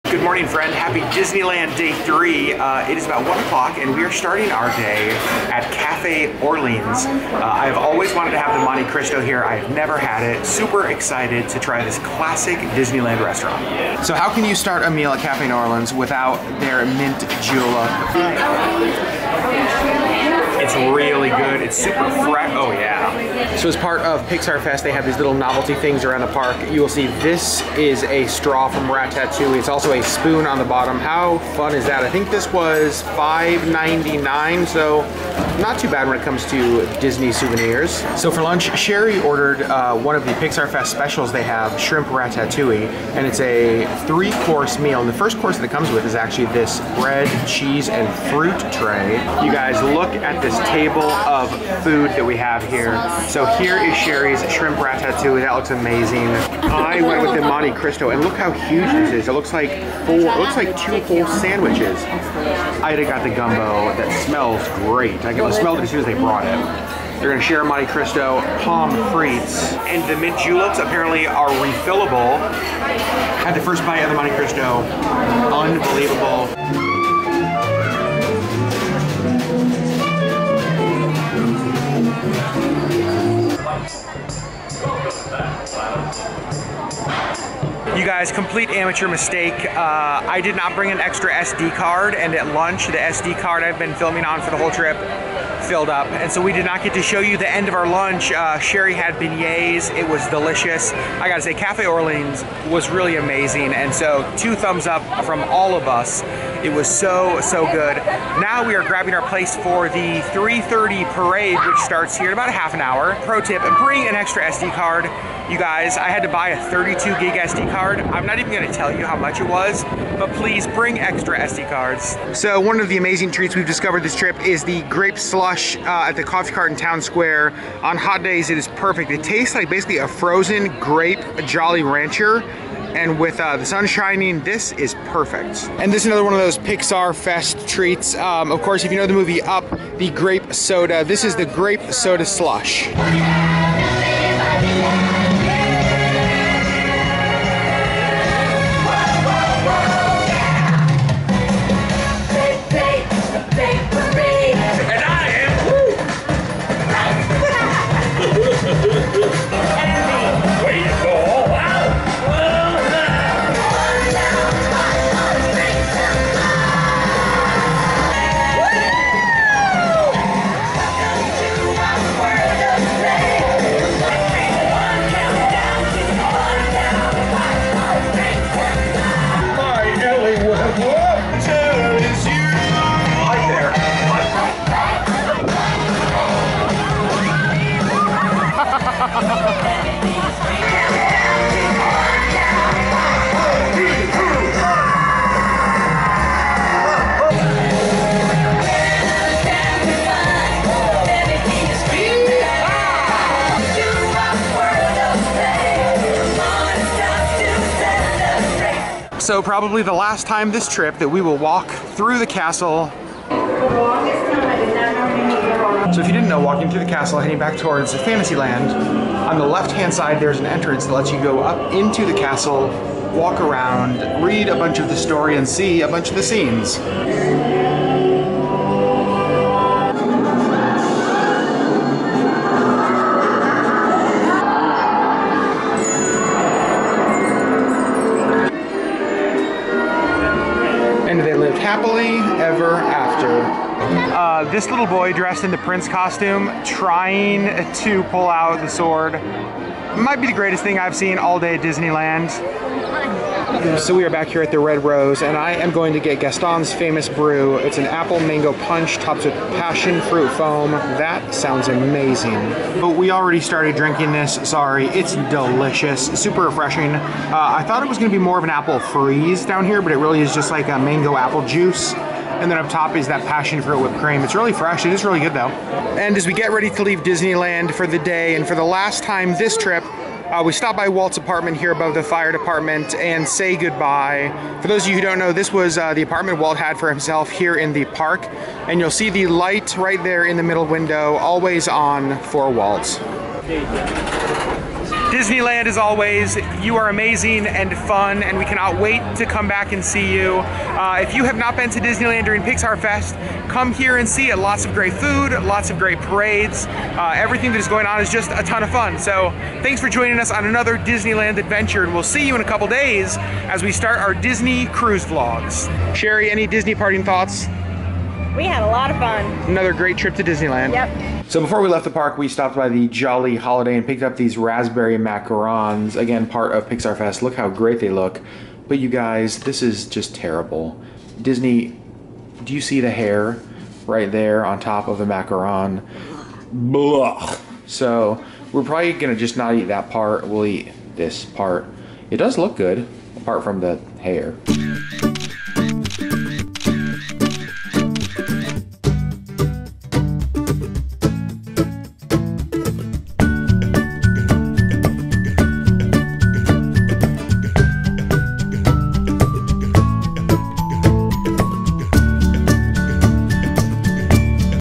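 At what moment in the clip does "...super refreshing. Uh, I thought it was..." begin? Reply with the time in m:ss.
4:26.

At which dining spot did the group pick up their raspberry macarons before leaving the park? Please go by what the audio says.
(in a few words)
Jolly Holiday.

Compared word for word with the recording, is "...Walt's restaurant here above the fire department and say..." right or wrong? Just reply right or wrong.
wrong.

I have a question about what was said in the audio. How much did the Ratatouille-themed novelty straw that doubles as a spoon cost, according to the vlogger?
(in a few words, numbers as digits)
$5.99.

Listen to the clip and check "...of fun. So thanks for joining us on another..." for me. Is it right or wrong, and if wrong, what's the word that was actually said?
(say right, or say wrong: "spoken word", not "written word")
right.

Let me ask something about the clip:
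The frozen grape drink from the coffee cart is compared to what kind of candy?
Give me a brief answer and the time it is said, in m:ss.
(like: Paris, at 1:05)
Grape Jolly Rancher, at 2:10.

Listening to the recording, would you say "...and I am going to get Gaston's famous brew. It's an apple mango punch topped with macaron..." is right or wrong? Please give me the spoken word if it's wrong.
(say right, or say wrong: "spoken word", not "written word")
wrong: "passion", not "macaron".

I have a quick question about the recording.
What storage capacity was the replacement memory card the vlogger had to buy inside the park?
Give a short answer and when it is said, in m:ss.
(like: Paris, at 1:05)
32 gig, at 1:56.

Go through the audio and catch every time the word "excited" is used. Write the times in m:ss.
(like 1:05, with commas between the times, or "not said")
0:10.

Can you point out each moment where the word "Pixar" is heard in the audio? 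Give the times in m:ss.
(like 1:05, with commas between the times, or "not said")
0:24, 0:40, 2:16, 5:02, 5:26.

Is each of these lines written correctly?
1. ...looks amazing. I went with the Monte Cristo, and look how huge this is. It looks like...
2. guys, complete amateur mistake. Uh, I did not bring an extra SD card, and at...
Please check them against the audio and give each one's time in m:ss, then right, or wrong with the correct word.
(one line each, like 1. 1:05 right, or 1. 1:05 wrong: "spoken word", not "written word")
1. 0:55 right
2. 1:28 right.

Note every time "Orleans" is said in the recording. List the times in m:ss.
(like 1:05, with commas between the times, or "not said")
0:06, 0:15, 1:41.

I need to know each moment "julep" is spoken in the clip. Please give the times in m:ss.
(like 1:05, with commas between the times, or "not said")
0:17, 1:10.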